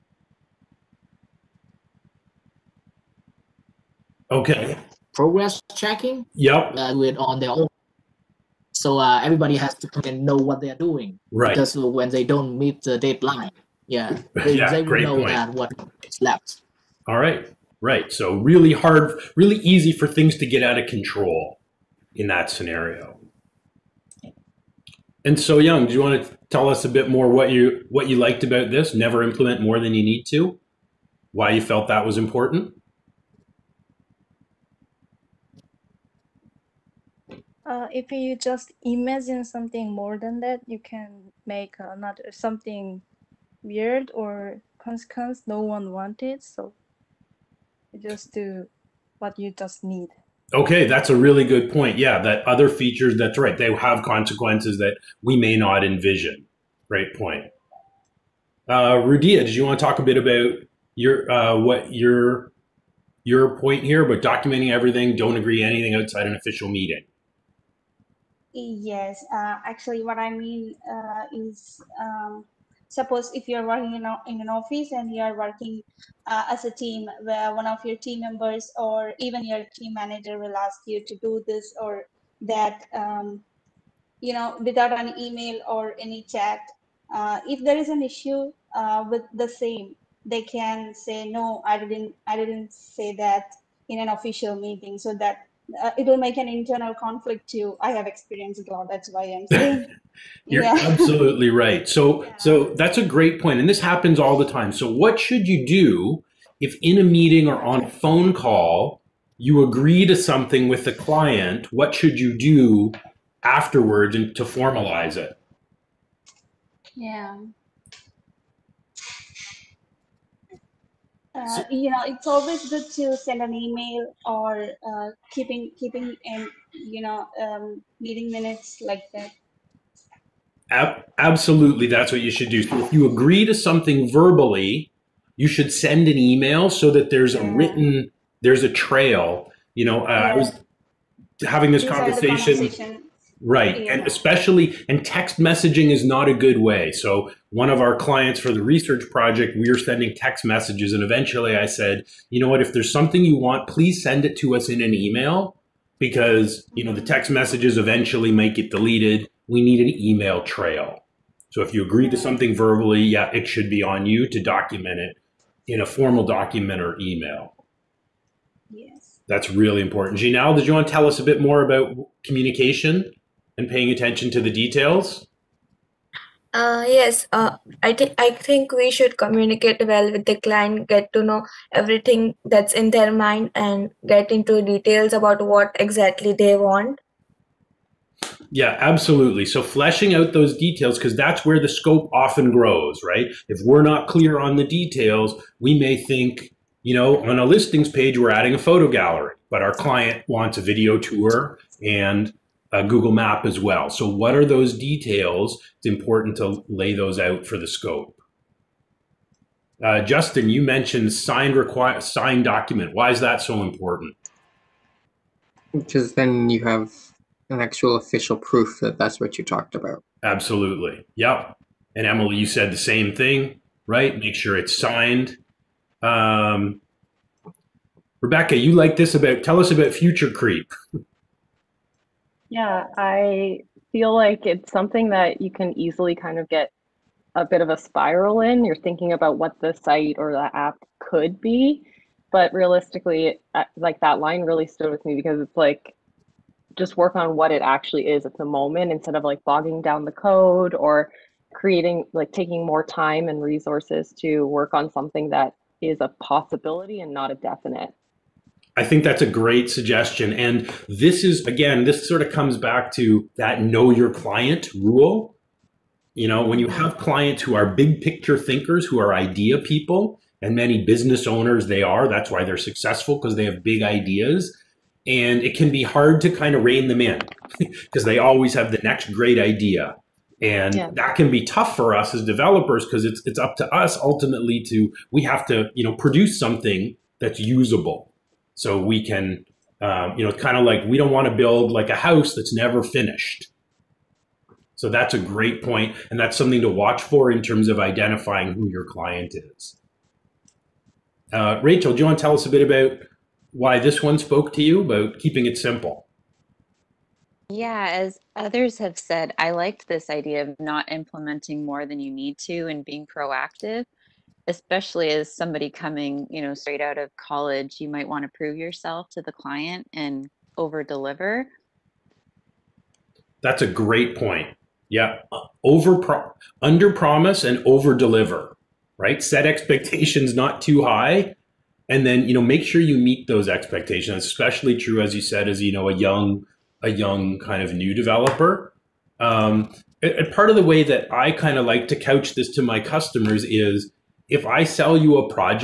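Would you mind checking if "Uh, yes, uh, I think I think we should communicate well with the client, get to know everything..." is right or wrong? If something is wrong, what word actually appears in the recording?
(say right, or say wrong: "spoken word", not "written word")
right.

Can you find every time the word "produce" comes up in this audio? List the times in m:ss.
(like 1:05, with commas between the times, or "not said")
4:45.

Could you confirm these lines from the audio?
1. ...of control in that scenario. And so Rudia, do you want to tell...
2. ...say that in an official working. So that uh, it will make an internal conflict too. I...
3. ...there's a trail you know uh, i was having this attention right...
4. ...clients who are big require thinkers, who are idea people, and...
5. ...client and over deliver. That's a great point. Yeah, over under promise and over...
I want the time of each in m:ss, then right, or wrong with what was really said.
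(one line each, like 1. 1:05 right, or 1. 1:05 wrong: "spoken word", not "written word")
1. 0:20 wrong: "Young", not "Rudia"
2. 1:32 wrong: "meeting", not "working"
3. 2:18 wrong: "conversation", not "attention"
4. 4:26 wrong: "picture", not "require"
5. 5:19 right.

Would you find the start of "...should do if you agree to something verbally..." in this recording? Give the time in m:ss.
2:12.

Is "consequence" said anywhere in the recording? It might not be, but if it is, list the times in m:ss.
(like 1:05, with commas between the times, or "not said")
0:44, 0:54.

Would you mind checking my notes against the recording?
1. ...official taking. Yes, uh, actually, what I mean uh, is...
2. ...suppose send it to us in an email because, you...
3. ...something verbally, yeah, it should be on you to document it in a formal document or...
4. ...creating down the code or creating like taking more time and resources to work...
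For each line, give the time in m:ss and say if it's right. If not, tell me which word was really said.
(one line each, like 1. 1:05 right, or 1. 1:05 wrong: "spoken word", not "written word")
1. 1:06 wrong: "meeting", not "taking"
2. 2:33 wrong: "please", not "suppose"
3. 2:42 right
4. 4:09 wrong: "bogging", not "creating".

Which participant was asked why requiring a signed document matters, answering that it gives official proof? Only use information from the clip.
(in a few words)
Justin.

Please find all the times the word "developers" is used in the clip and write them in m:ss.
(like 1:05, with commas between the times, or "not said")
4:42, 5:37.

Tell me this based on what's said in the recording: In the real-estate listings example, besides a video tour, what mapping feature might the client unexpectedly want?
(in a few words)
Google Map.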